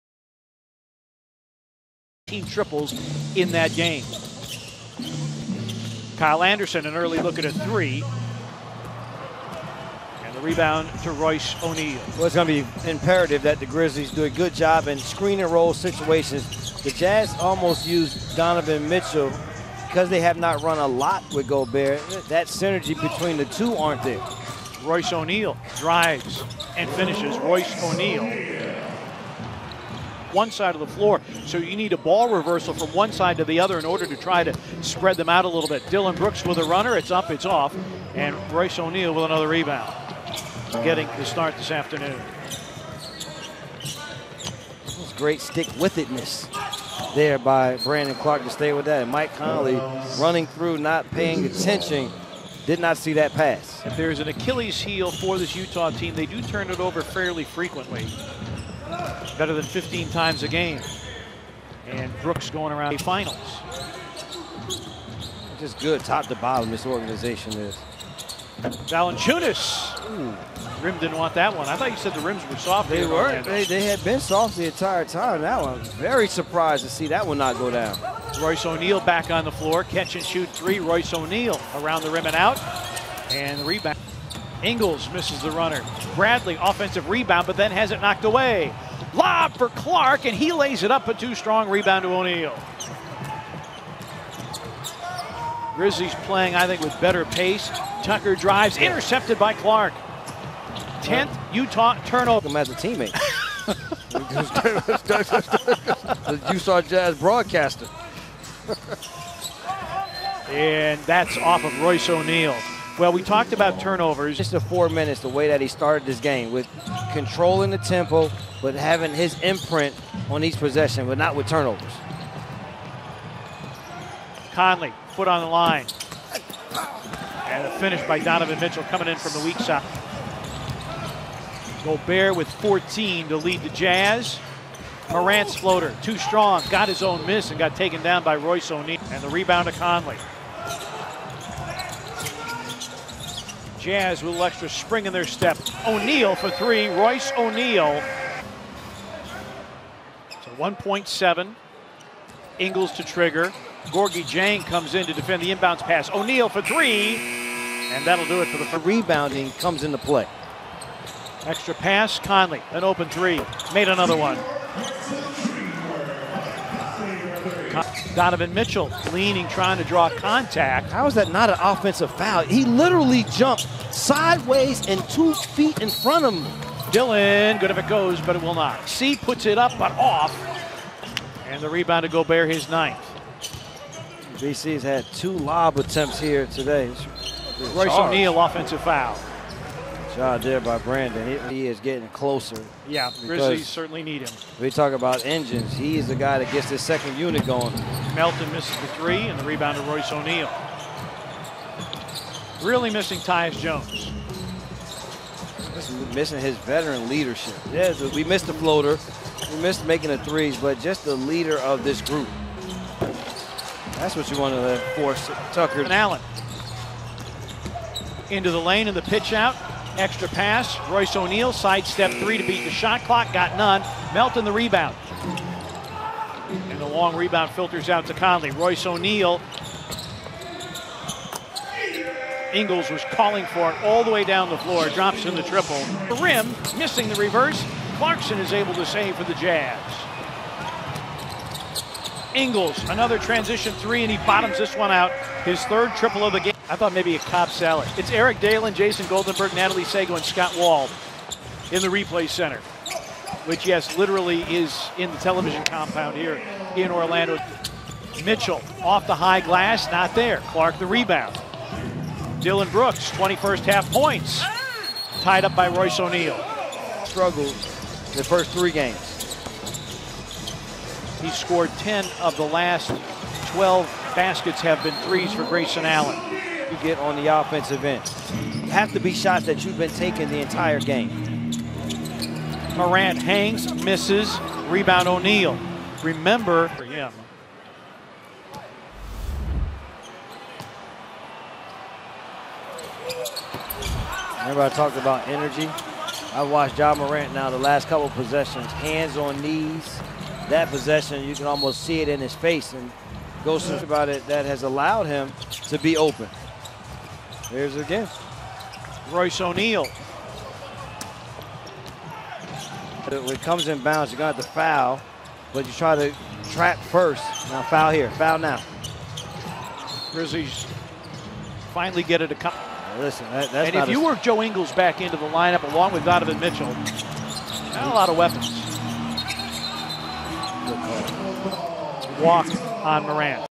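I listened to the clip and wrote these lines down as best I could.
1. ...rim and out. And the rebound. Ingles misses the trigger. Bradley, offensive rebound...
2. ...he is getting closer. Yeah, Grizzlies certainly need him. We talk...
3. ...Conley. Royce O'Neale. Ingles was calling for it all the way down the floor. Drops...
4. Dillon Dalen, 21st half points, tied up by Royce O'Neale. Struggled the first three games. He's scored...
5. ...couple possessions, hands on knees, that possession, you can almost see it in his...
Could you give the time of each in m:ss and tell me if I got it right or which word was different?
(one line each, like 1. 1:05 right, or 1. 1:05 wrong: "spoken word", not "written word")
1. 1:22 wrong: "runner", not "trigger"
2. 3:11 right
3. 3:48 right
4. 4:22 wrong: "Brooks", not "Dalen"
5. 4:57 right.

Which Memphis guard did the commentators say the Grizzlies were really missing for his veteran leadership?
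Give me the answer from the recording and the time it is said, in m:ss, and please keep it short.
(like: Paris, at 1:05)
Tyus Jones, at 3:23.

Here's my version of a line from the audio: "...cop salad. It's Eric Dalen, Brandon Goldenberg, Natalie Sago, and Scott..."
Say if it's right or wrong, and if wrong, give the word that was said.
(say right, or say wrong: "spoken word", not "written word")
wrong: "Jason", not "Brandon".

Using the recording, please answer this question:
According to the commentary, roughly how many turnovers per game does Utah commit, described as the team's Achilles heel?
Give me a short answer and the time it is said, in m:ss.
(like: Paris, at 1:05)
15, at 0:59.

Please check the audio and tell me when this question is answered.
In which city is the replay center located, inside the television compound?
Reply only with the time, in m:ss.
4:16.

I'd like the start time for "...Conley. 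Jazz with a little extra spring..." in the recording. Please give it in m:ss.
2:19.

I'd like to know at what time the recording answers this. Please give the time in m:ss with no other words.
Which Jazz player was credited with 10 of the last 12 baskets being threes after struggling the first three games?
4:35.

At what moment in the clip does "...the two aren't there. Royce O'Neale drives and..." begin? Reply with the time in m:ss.
0:23.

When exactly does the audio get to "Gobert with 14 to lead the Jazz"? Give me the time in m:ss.
2:11.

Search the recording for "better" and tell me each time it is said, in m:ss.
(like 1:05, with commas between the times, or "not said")
0:59, 1:37.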